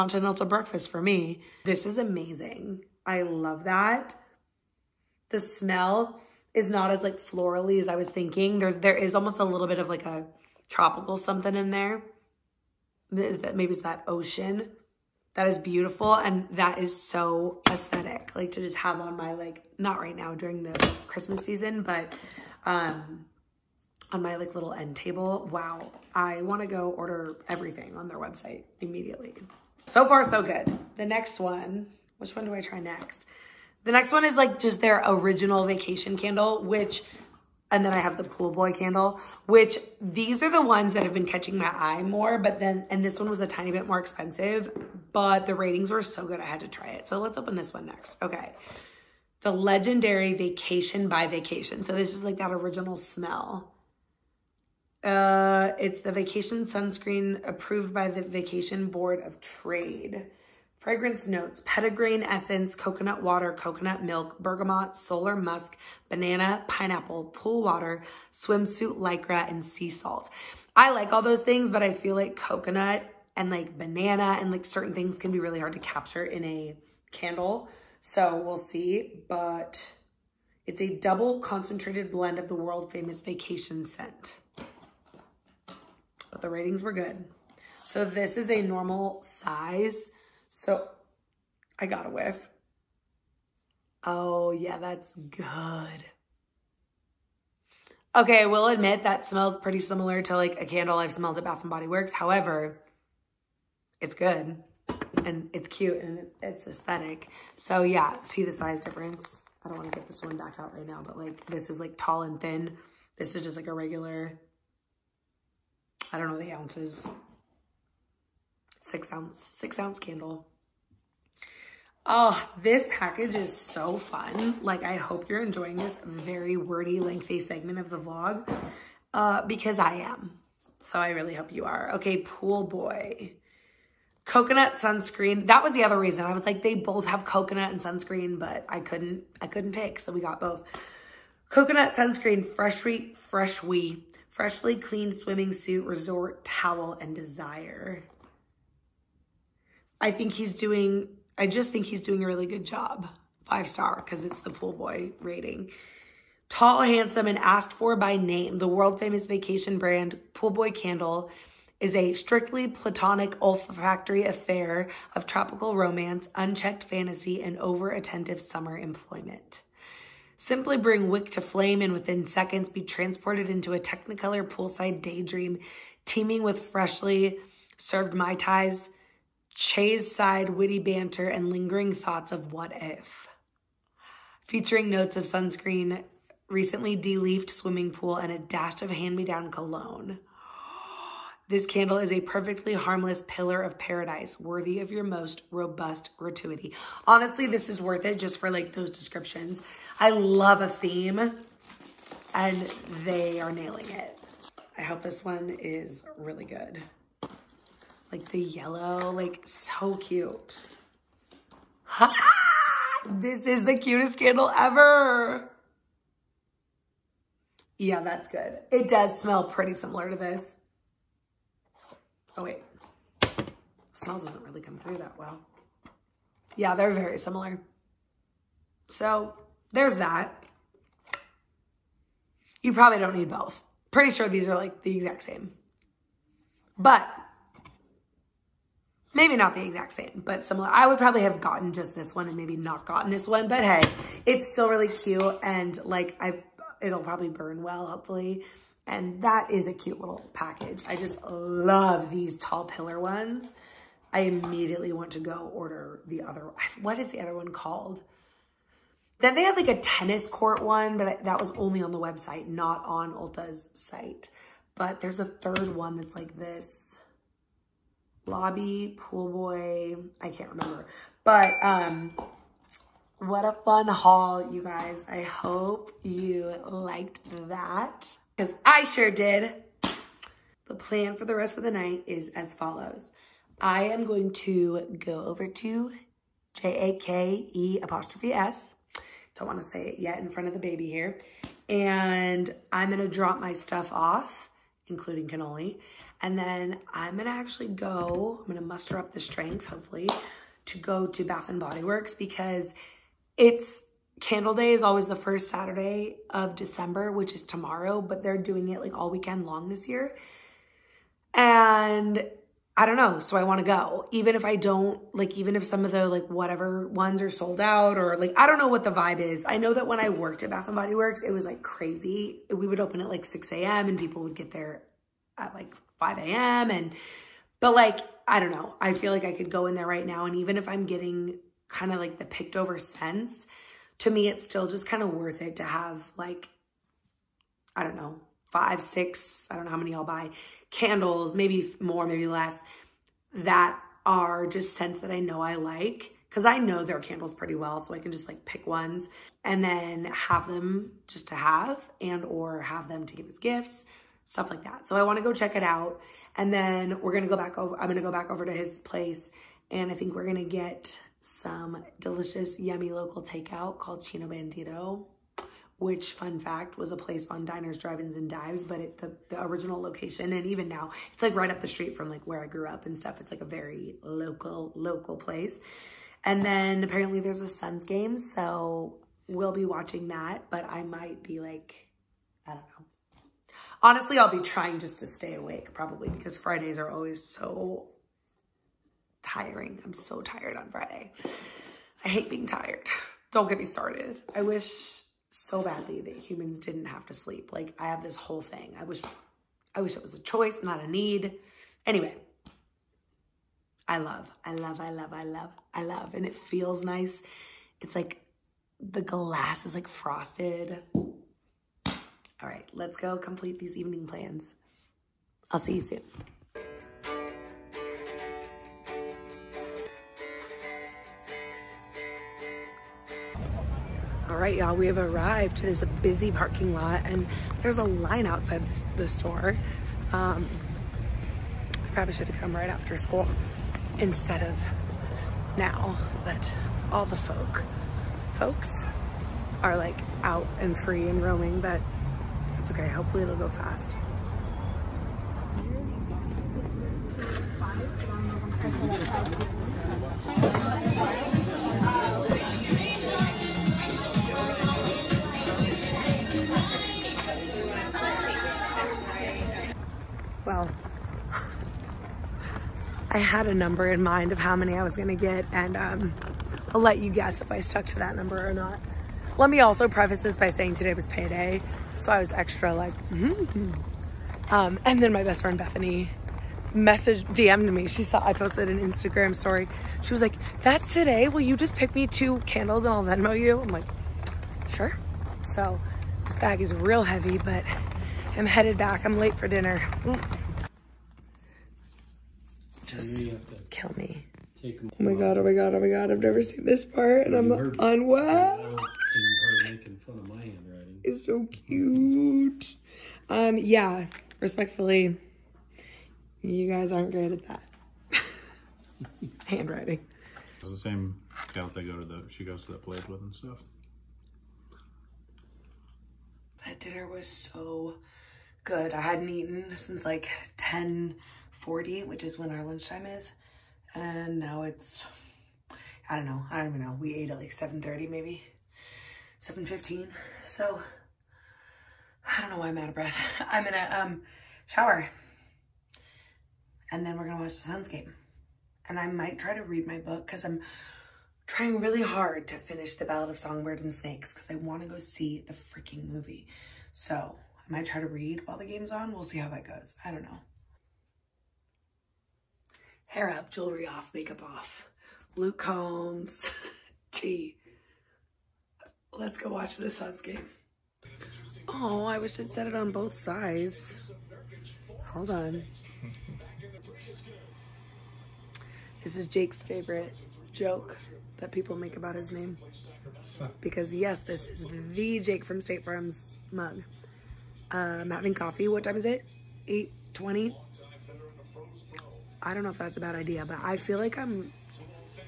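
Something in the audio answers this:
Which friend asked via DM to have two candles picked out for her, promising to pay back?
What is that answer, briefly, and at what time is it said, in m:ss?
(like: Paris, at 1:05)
Bethany, at 7:55.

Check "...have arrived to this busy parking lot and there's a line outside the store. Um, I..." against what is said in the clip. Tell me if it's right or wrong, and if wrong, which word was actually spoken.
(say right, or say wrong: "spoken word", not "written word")
right.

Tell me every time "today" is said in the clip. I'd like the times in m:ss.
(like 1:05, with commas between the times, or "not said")
7:50, 8:00.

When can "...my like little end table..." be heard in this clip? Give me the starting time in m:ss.
0:24.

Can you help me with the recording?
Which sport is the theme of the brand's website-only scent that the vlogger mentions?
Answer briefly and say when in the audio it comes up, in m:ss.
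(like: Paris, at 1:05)
Tennis, at 4:19.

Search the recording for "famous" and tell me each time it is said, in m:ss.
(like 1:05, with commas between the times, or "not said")
1:22, 2:38.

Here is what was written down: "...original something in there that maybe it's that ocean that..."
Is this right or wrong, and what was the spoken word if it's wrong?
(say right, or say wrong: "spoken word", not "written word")
wrong: "tropical", not "original".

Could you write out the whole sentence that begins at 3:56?
But maybe not the exact same, but similar.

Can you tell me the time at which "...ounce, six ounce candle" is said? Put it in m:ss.
1:59.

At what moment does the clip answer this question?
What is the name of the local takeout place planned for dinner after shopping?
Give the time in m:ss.
6:04.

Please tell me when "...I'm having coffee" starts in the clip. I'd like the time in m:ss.
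9:37.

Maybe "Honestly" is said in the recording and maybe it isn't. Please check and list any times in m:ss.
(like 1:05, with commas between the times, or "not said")
3:17, 6:23.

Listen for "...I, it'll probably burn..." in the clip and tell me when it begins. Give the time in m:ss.
4:06.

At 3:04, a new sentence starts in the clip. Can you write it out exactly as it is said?
Featuring notes of sunscreen, recently de-leafed swimming pool, and a dash of hand-me-down cologne.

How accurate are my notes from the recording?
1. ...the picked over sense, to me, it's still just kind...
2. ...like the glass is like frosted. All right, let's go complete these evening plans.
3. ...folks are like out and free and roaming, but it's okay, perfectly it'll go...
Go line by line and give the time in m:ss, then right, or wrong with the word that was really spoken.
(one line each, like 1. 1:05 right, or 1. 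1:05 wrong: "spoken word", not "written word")
1. 5:32 right
2. 6:47 right
3. 7:18 wrong: "hopefully", not "perfectly".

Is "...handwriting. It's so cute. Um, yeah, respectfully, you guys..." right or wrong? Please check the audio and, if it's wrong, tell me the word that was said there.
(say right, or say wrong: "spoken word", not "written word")
right.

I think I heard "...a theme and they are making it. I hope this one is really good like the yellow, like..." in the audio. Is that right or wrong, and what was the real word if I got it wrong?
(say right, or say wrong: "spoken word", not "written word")
wrong: "nailing", not "making".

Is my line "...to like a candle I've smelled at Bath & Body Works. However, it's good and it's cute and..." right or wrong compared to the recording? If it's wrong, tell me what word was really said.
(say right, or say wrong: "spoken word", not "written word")
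right.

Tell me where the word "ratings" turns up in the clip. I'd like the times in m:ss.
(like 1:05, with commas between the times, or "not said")
0:45, 1:26, 2:35.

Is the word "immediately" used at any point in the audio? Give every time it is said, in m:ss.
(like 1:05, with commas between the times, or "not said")
0:28, 4:14.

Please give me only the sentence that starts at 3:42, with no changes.
Oh wait, the smell doesn't really come through that well.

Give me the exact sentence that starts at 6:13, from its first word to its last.
It's like a very local, local place.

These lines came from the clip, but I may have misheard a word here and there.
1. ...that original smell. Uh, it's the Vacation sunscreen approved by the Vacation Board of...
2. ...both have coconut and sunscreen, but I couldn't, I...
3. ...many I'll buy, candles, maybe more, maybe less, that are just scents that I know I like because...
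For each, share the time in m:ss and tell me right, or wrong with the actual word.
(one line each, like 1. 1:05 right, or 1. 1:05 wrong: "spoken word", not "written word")
1. 0:52 right
2. 2:16 right
3. 5:39 right.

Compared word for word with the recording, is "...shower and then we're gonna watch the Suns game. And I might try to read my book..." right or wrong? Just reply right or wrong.
right.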